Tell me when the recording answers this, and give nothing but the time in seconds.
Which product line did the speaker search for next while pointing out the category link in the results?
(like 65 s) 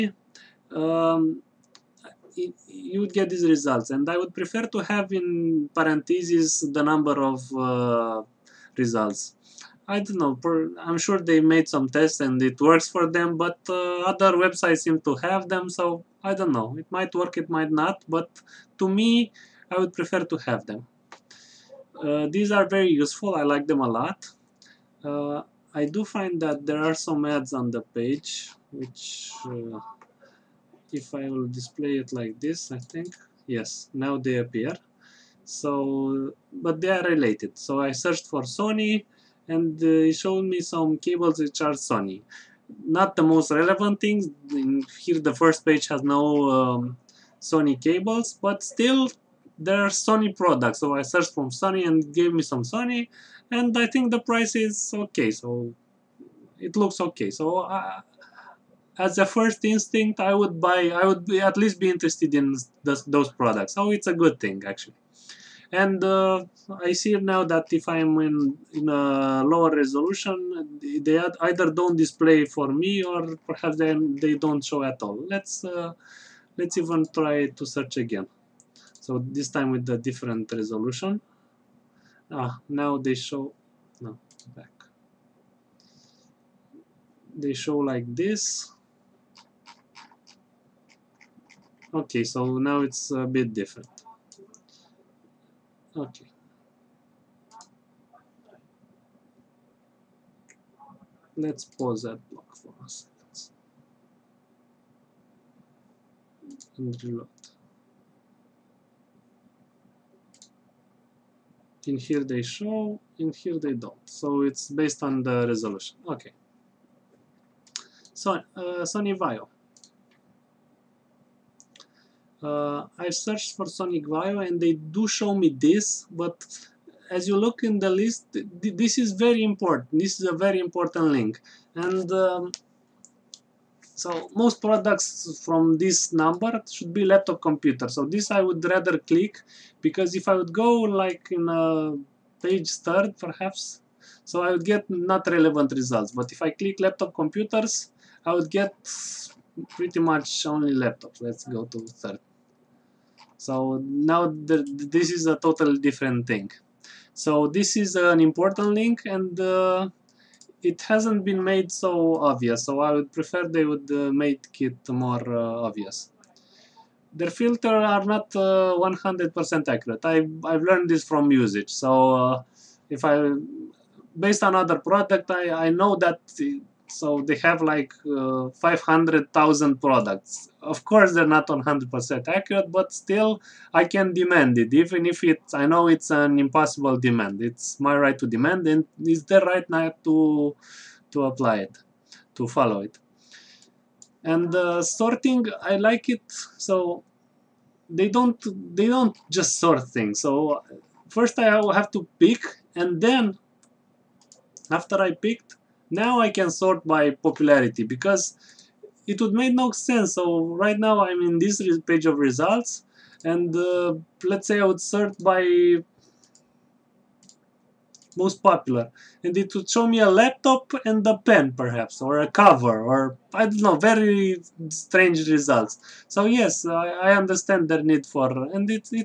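118 s.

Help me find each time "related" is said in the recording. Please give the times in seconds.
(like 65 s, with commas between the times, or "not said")
37 s.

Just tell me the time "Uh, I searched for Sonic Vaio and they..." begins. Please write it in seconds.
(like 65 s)
122 s.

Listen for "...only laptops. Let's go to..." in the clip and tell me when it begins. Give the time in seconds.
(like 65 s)
150 s.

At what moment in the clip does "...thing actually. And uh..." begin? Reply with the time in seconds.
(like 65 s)
64 s.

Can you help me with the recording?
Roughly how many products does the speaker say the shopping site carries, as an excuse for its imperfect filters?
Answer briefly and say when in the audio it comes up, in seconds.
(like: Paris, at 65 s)
500,000, at 178 s.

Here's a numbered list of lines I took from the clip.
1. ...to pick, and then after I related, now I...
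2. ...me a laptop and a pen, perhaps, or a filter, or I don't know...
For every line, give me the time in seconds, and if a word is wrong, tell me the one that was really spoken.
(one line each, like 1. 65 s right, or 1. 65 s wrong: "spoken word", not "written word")
1. 201 s wrong: "picked", not "related"
2. 219 s wrong: "cover", not "filter".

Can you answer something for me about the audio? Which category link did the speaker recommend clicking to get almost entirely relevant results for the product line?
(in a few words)
laptop computers.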